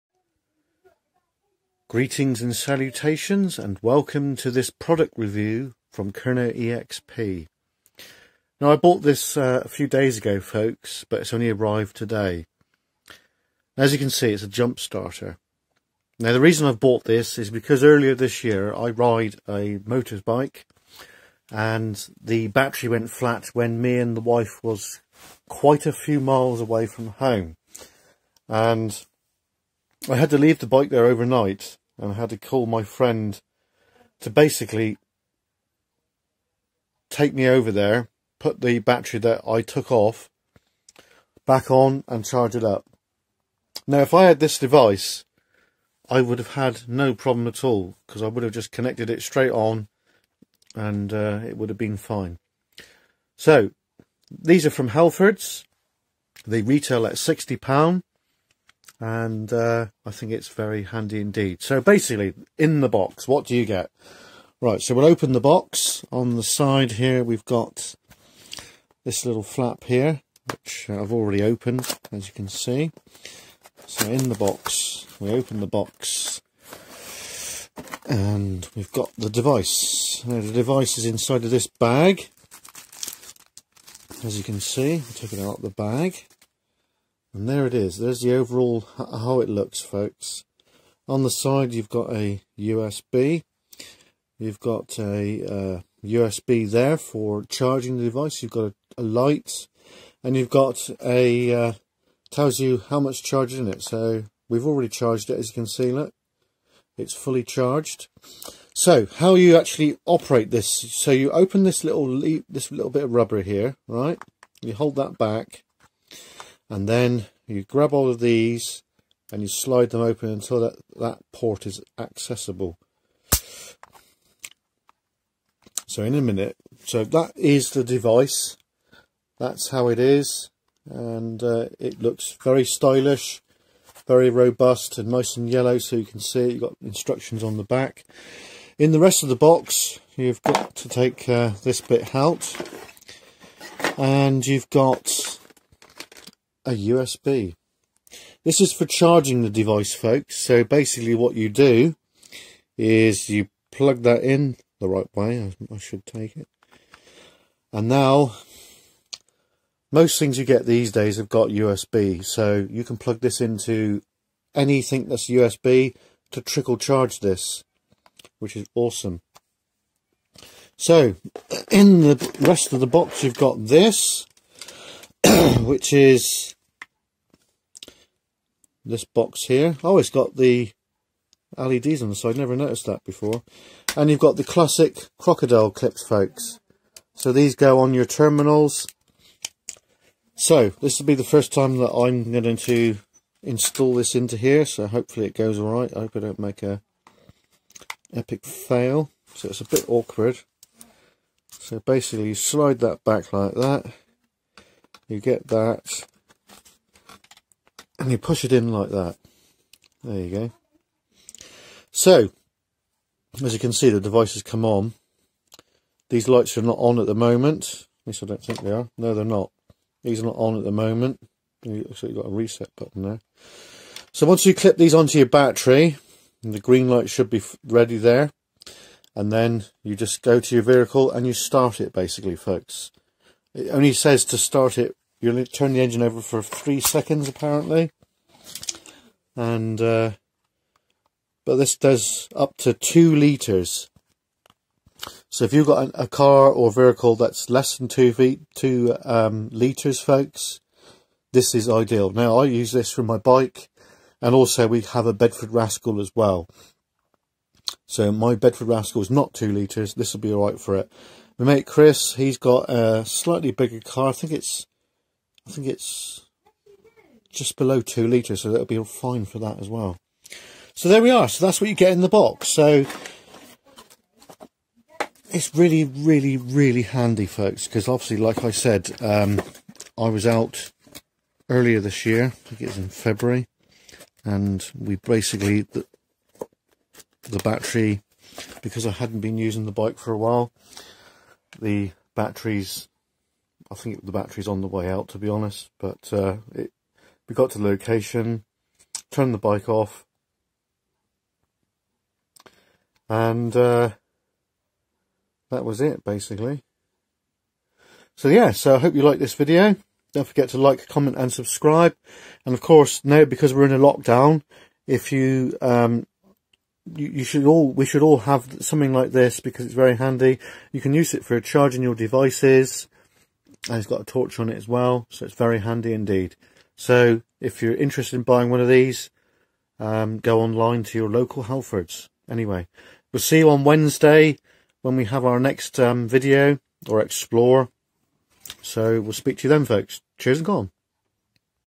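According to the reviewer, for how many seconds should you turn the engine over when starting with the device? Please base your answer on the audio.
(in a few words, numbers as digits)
3.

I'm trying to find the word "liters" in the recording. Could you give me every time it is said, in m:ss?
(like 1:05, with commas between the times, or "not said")
4:03, 4:09, 4:19.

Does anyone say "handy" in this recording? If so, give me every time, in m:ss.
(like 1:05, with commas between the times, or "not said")
1:00, 4:36, 5:19, 5:25.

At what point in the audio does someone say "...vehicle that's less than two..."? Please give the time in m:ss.
4:06.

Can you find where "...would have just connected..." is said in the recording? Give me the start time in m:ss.
0:48.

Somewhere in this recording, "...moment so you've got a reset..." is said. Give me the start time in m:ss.
3:40.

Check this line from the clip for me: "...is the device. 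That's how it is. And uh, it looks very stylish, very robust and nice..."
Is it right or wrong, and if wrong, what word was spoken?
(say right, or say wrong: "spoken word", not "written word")
right.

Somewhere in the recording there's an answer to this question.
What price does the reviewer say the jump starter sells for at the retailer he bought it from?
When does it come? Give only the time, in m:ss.
0:57.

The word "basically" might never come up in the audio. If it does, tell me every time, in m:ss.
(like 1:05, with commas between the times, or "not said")
0:34, 1:01, 2:30, 3:21, 3:51, 4:44, 5:06.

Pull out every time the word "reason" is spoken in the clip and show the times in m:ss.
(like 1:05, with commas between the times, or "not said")
0:16.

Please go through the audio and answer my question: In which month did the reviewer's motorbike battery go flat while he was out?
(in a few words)
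February.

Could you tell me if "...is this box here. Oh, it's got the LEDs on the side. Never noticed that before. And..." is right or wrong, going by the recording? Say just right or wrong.
right.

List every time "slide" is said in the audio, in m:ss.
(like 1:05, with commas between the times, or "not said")
1:59, 3:22.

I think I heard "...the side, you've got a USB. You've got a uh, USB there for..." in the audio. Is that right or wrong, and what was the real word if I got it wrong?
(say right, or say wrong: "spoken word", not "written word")
right.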